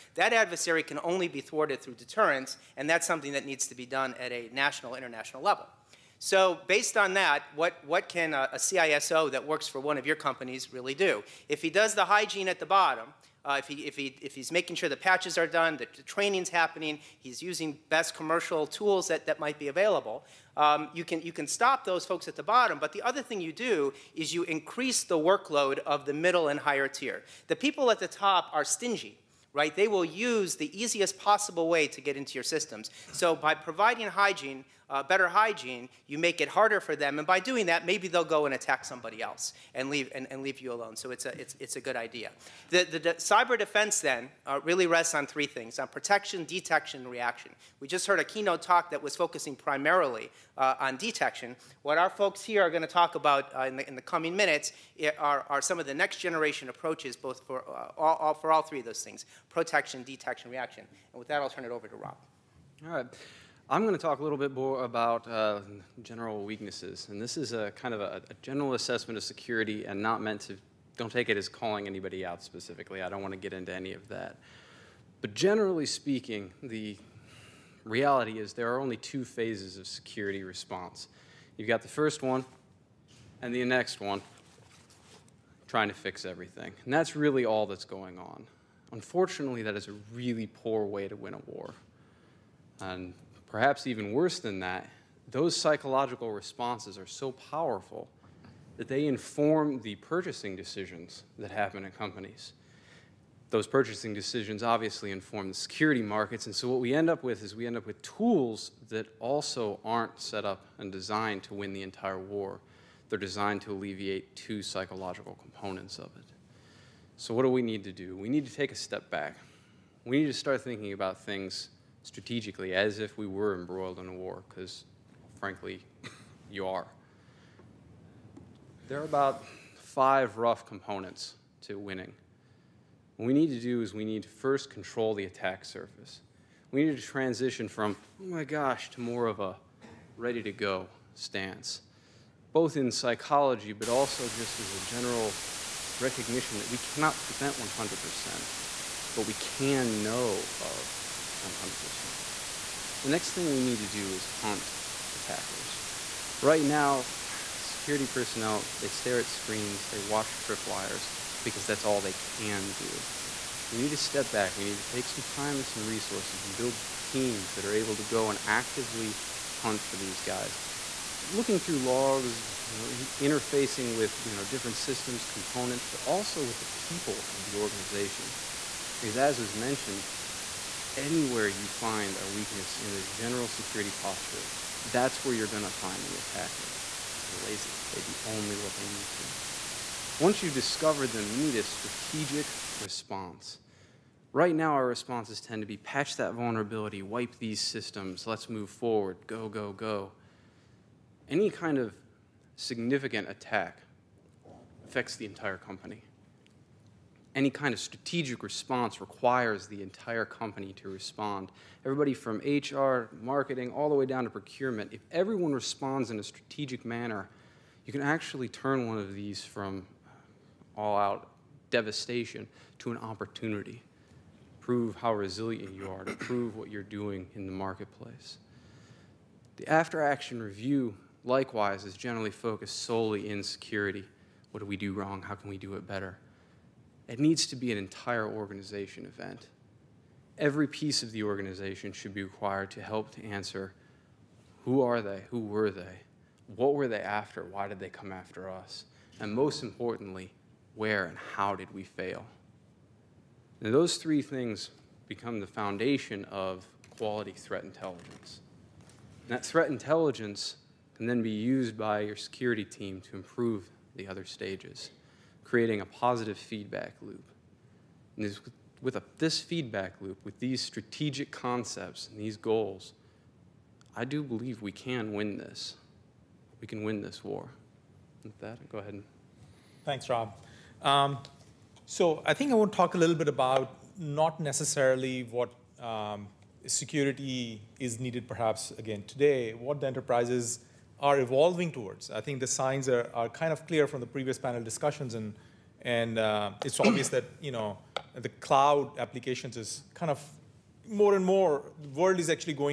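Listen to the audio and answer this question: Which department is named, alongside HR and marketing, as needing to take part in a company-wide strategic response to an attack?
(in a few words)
Procurement.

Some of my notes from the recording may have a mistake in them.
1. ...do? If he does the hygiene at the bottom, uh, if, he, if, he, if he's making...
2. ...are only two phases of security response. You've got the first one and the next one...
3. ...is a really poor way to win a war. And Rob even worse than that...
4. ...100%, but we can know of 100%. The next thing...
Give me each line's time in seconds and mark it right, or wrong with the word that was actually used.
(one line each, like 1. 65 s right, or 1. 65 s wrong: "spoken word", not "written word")
1. 10 s right
2. 78 s right
3. 89 s wrong: "Perhaps", not "Rob"
4. 147 s right.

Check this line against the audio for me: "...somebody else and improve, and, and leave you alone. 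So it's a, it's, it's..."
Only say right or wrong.
wrong.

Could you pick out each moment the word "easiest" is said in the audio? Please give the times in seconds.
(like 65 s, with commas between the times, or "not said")
30 s.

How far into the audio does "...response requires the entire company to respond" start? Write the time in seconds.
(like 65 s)
208 s.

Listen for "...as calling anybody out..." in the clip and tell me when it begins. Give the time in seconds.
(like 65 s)
71 s.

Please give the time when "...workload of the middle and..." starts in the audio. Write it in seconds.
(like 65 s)
25 s.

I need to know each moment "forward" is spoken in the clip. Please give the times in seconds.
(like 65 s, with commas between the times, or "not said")
198 s.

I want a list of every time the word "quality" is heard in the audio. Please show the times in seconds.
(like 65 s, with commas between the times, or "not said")
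256 s.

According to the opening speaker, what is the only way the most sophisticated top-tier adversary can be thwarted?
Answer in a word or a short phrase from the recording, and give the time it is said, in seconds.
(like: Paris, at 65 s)
Deterrence, at 1 s.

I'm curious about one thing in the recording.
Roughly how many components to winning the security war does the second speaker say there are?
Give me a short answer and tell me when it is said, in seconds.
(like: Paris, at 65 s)
5, at 129 s.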